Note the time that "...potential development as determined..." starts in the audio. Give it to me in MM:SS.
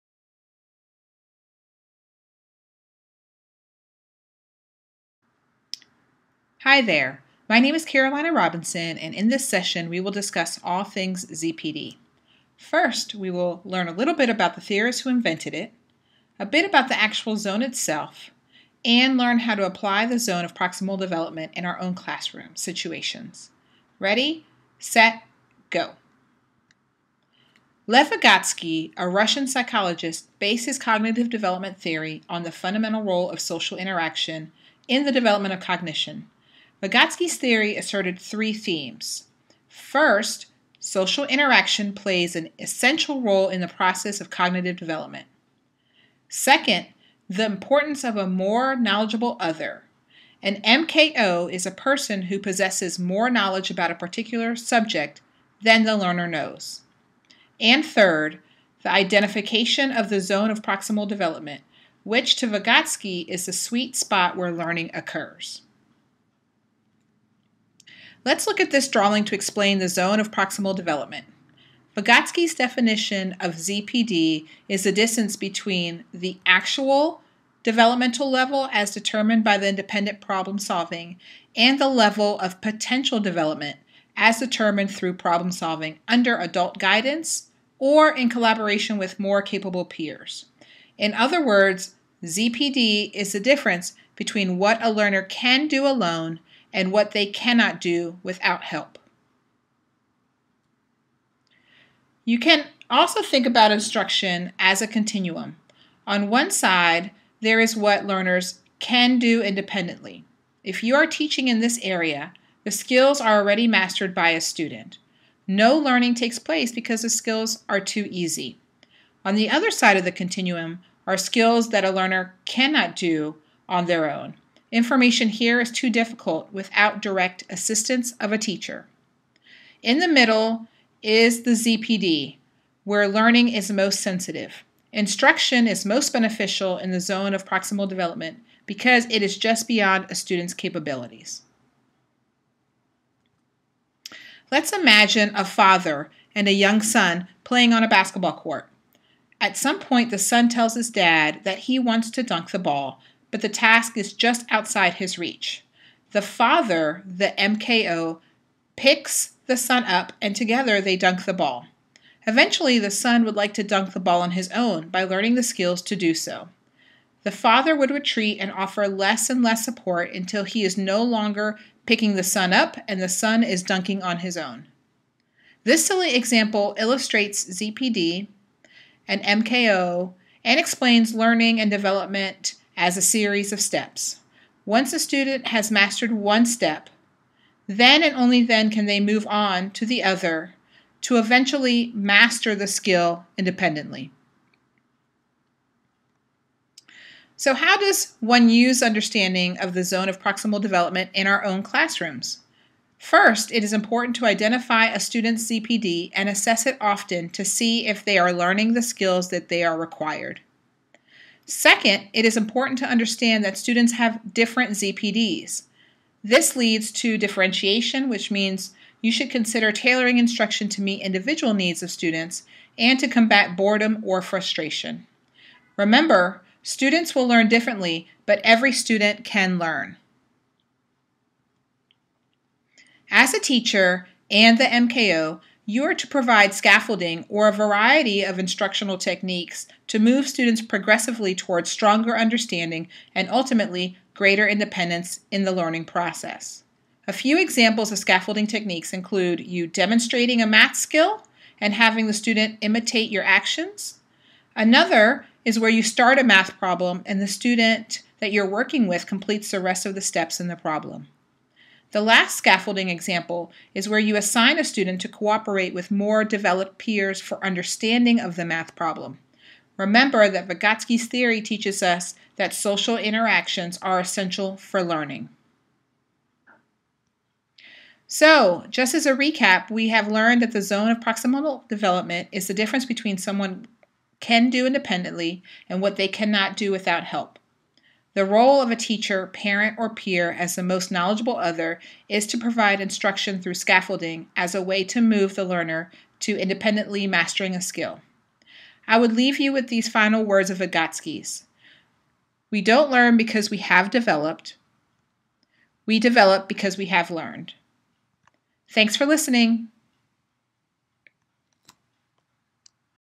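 01:22.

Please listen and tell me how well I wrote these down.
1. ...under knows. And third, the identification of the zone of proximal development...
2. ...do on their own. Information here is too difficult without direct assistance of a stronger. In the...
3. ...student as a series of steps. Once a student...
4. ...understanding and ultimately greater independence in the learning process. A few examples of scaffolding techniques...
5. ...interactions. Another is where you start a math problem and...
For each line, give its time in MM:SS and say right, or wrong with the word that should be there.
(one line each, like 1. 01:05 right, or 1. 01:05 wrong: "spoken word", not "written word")
1. 00:55 wrong: "learner", not "under"
2. 02:02 wrong: "teacher", not "stronger"
3. 03:01 wrong: "development", not "student"
4. 04:02 right
5. 04:13 wrong: "actions", not "interactions".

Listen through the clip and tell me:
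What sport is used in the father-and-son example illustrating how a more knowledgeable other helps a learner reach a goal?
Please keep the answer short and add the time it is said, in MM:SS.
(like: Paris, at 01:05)
basketball, at 02:27.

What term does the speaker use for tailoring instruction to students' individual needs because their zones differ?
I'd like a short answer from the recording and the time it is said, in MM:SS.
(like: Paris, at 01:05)
differentiation, at 03:37.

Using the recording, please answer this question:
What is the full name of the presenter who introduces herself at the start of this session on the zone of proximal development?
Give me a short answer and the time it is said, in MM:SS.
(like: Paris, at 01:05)
Carolina Robinson, at 00:07.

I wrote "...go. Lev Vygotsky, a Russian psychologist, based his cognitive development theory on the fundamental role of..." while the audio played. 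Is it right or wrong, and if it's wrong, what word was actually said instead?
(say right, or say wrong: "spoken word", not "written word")
right.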